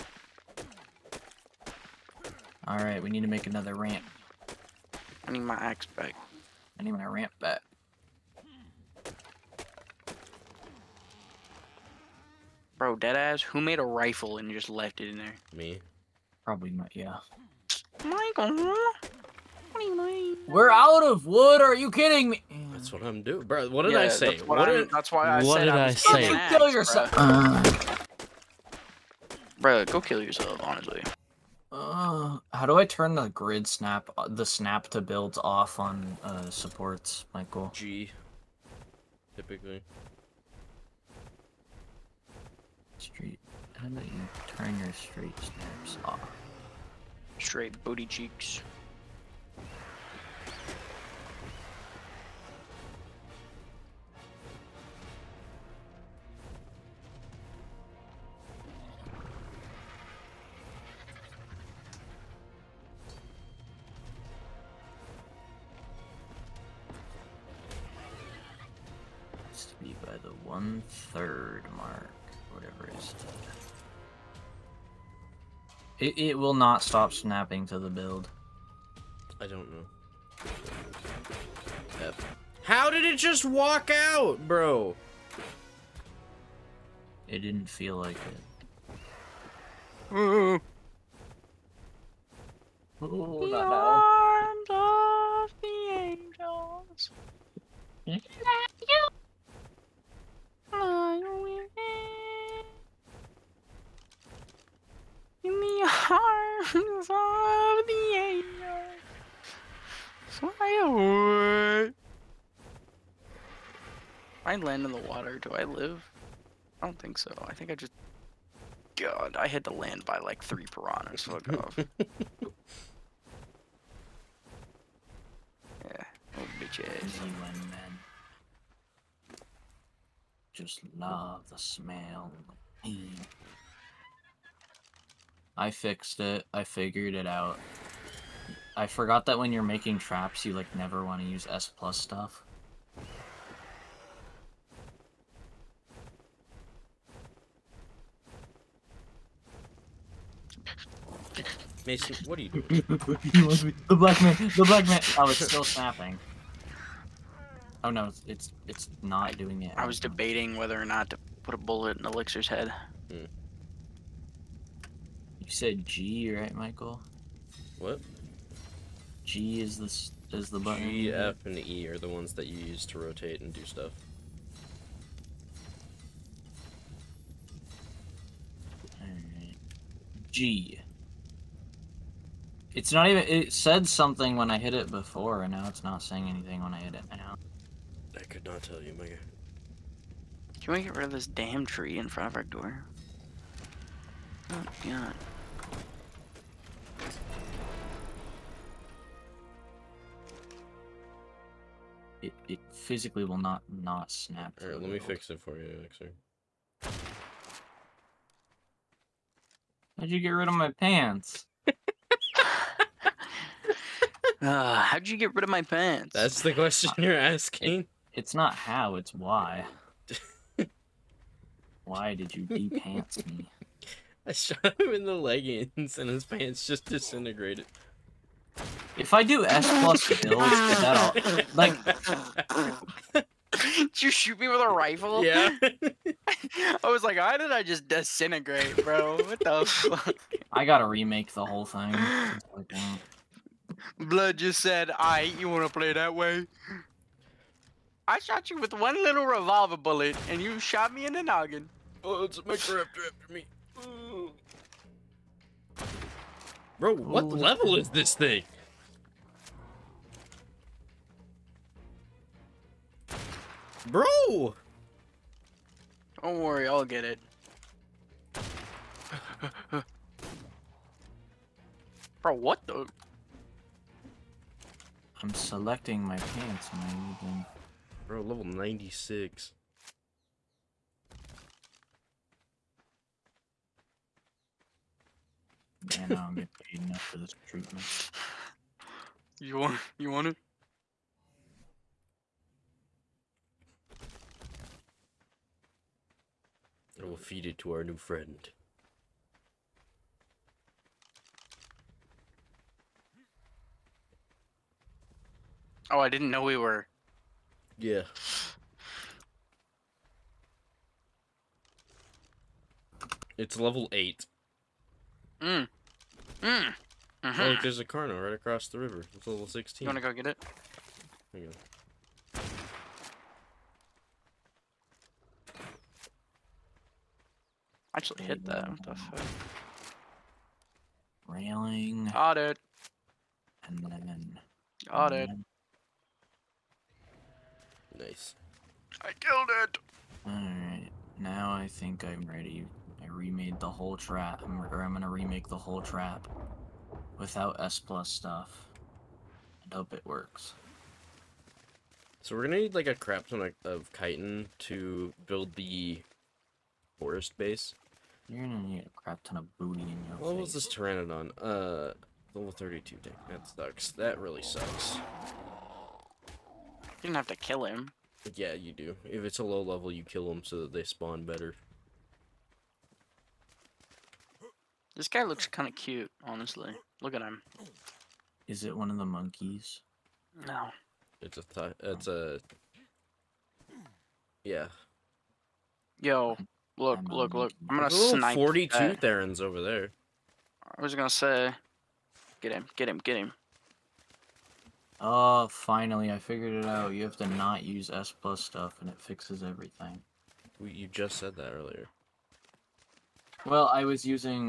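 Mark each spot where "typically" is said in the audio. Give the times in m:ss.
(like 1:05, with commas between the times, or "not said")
0:39.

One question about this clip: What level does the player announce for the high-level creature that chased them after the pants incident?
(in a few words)
96.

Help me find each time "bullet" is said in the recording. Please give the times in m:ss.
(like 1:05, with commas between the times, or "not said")
2:41, 4:09.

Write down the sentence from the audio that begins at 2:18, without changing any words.
I forgot that when you're making traps, you like never want to use S plus stuff.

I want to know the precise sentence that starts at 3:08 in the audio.
I could not tell you, Mega.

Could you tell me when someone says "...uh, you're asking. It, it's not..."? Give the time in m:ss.
3:36.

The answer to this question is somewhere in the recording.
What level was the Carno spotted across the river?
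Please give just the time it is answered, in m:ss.
5:19.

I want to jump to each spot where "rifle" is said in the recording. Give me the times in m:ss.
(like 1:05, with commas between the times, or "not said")
0:13, 3:54.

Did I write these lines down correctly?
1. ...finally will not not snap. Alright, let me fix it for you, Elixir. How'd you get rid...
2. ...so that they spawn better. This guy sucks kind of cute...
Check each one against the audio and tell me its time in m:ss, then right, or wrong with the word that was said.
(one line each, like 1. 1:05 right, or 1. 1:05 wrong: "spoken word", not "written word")
1. 3:22 wrong: "physically", not "finally"
2. 6:10 wrong: "looks", not "sucks".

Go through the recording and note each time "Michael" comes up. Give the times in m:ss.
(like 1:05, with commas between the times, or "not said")
0:18, 0:37, 2:46.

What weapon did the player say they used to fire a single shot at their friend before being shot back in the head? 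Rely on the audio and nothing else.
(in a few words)
Revolver.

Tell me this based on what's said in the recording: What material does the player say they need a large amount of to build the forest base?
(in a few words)
Chitin.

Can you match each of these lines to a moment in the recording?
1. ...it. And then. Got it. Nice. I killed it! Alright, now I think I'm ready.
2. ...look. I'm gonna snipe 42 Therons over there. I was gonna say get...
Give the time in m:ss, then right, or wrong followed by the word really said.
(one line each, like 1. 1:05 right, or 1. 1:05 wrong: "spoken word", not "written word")
1. 5:32 right
2. 6:27 right.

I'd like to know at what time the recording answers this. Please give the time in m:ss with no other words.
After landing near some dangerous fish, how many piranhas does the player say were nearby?
2:00.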